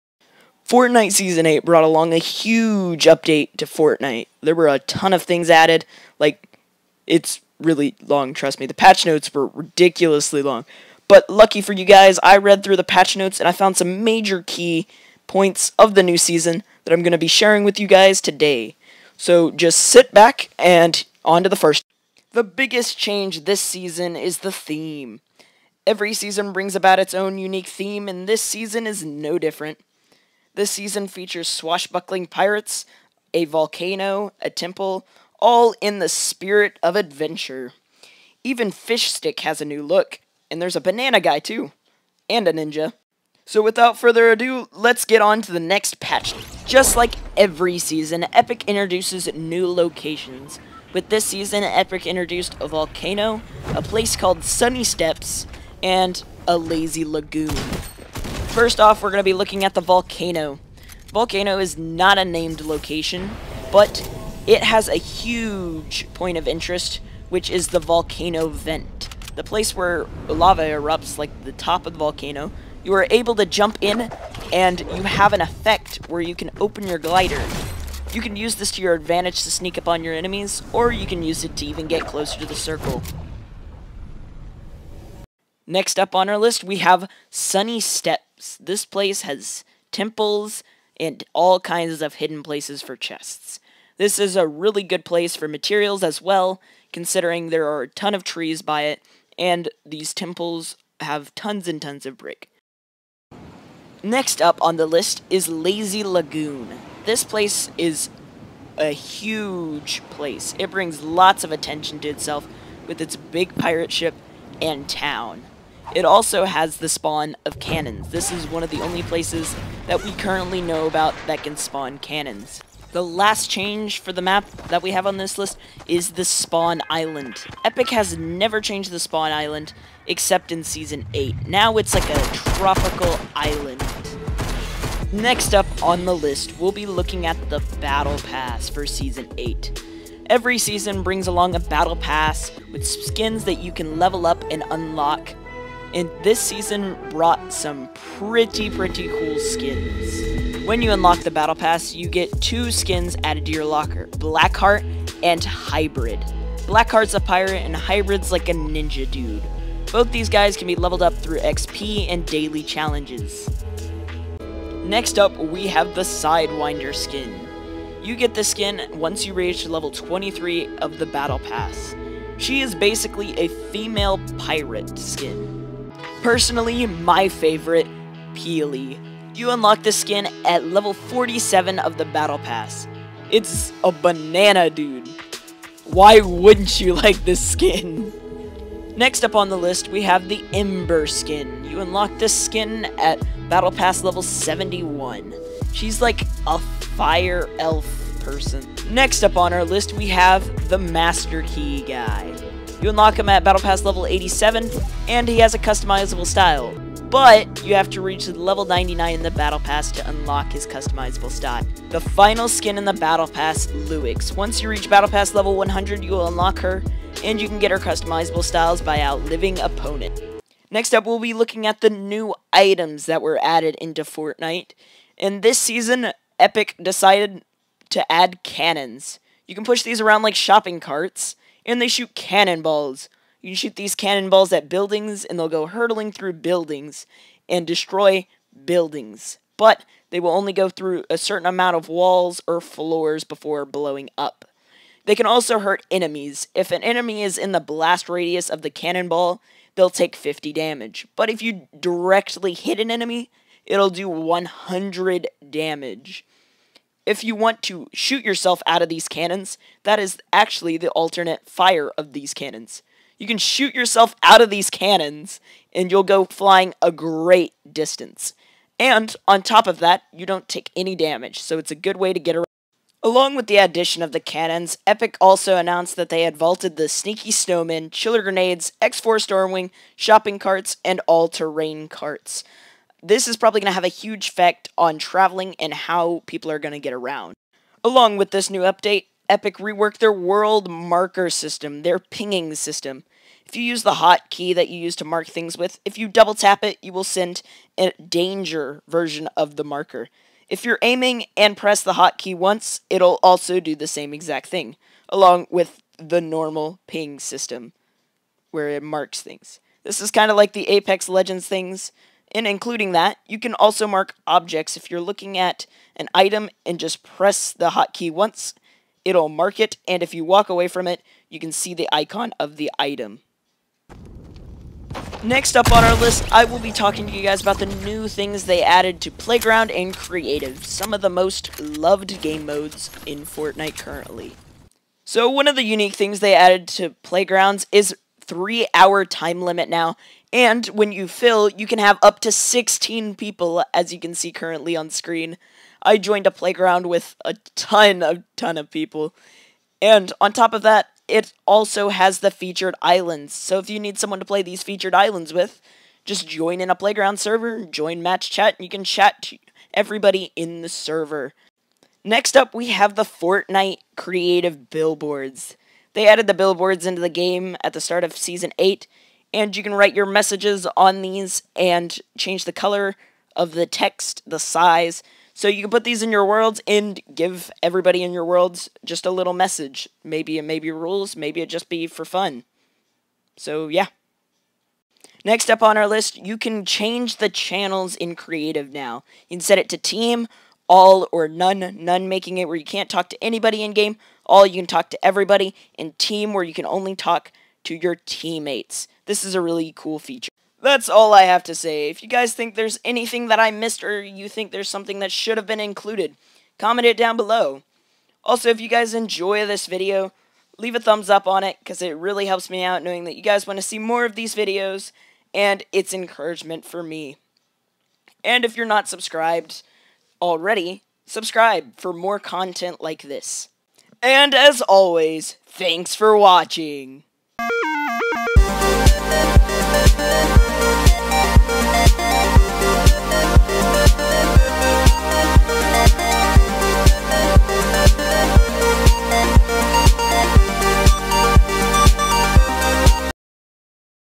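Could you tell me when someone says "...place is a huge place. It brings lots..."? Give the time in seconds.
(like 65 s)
107 s.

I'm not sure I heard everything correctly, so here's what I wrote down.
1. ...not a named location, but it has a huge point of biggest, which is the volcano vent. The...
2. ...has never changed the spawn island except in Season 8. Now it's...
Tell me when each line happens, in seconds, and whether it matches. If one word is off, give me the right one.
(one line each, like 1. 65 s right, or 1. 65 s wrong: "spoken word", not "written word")
1. 61 s wrong: "interest", not "biggest"
2. 127 s right.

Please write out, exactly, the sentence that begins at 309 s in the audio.
This is kind of like the Apex Legends things, in including that, you can also mark objects.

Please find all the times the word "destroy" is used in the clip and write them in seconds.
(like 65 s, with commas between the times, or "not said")
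237 s.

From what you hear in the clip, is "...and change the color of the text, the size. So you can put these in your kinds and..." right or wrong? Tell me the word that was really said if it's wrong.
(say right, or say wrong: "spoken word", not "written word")
wrong: "worlds", not "kinds".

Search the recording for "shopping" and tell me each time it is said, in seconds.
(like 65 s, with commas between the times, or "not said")
230 s, 279 s.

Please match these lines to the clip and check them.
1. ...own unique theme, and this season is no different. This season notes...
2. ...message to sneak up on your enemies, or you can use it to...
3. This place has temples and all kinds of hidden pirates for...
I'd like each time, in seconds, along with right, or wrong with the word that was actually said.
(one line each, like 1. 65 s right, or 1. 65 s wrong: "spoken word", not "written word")
1. 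27 s wrong: "features", not "notes"
2. 78 s wrong: "advantage", not "message"
3. 88 s wrong: "places", not "pirates".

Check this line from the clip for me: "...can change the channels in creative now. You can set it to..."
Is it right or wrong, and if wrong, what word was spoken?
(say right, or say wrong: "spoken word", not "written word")
right.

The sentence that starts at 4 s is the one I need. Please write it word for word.
There were a ton of things added.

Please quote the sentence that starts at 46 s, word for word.
Just like every season, Epic introduces new locations.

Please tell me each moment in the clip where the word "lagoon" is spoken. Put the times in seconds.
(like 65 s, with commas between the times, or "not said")
57 s, 106 s.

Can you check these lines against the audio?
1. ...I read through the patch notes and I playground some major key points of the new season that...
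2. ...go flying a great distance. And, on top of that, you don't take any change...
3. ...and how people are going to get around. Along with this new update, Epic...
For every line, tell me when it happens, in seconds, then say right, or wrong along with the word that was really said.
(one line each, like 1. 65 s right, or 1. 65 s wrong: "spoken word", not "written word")
1. 12 s wrong: "found", not "playground"
2. 266 s wrong: "damage", not "change"
3. 285 s right.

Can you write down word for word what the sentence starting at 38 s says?
Even Fish Stick has a new look, and there's a banana guy too, and a ninja.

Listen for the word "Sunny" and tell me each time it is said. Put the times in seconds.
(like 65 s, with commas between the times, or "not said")
54 s, 87 s.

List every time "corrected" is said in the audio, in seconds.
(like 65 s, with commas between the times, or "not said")
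not said.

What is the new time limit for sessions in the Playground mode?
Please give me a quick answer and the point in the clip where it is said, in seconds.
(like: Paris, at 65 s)
3 hours, at 338 s.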